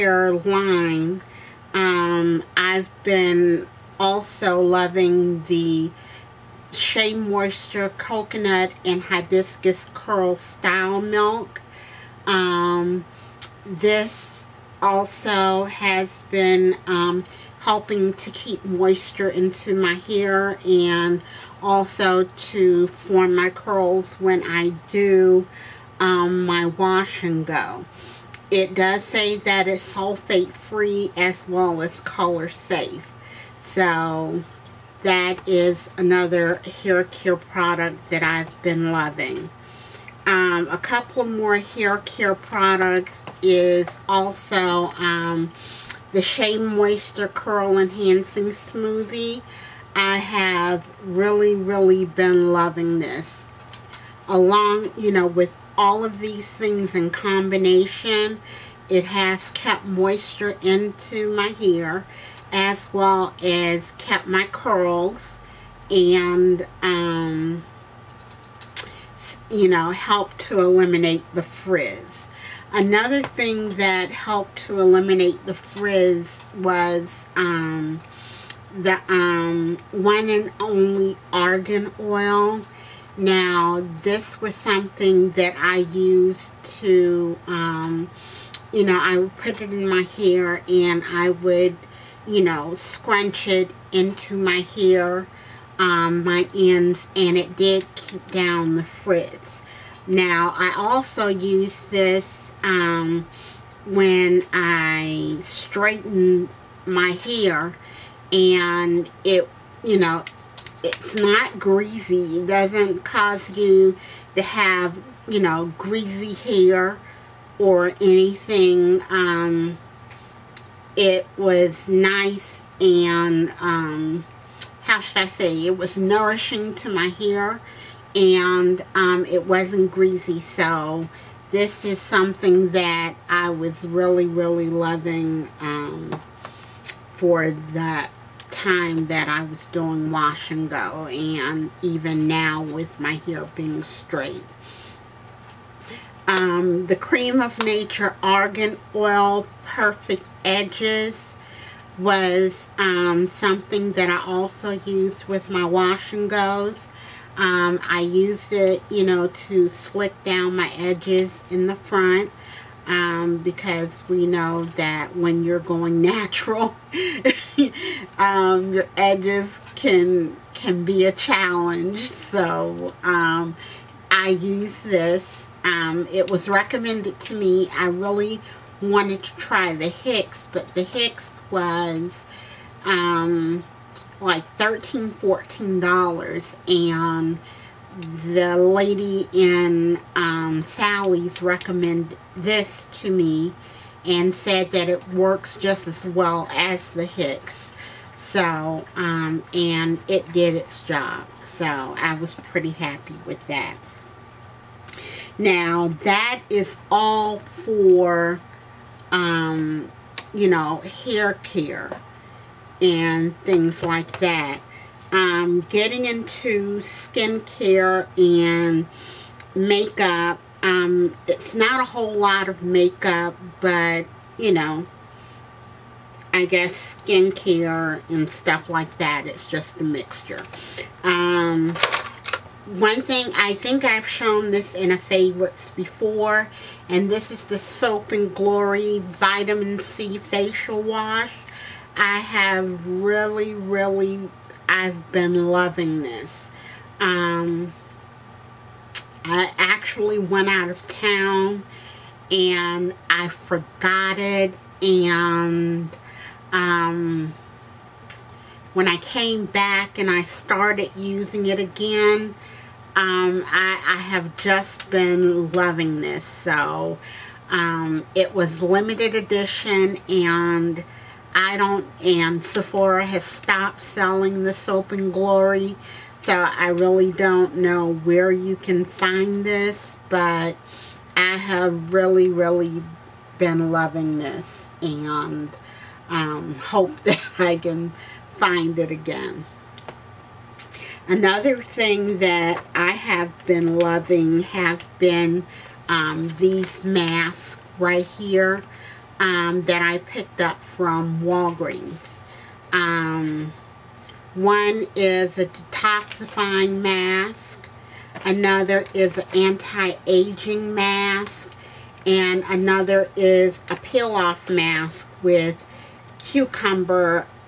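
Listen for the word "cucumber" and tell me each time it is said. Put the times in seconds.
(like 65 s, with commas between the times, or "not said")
316 s.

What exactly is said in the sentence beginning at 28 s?
It does say that it's sulfate free as well as color safe.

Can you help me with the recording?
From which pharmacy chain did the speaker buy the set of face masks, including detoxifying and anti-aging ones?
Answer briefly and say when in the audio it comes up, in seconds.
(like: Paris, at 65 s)
Walgreens, at 301 s.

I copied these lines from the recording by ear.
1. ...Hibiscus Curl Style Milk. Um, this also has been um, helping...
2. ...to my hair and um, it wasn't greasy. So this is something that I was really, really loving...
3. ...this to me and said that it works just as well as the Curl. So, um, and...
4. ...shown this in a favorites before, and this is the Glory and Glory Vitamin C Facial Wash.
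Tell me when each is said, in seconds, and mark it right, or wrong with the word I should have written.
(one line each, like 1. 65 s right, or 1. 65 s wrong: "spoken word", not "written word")
1. 9 s right
2. 126 s right
3. 192 s wrong: "Hicks", not "Curl"
4. 234 s wrong: "Soap", not "Glory".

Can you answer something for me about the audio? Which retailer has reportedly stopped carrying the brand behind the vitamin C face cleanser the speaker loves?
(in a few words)
Sephora.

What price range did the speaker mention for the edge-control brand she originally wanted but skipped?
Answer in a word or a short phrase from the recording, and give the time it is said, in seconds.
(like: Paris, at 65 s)
$13, $14, at 184 s.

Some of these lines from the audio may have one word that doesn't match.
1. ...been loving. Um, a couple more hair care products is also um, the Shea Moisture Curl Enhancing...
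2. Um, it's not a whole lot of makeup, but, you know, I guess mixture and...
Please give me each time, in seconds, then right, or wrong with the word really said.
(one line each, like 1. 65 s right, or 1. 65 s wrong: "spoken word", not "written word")
1. 38 s right
2. 220 s wrong: "skincare", not "mixture".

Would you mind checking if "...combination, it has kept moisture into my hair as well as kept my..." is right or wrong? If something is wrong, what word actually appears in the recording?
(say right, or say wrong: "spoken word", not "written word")
right.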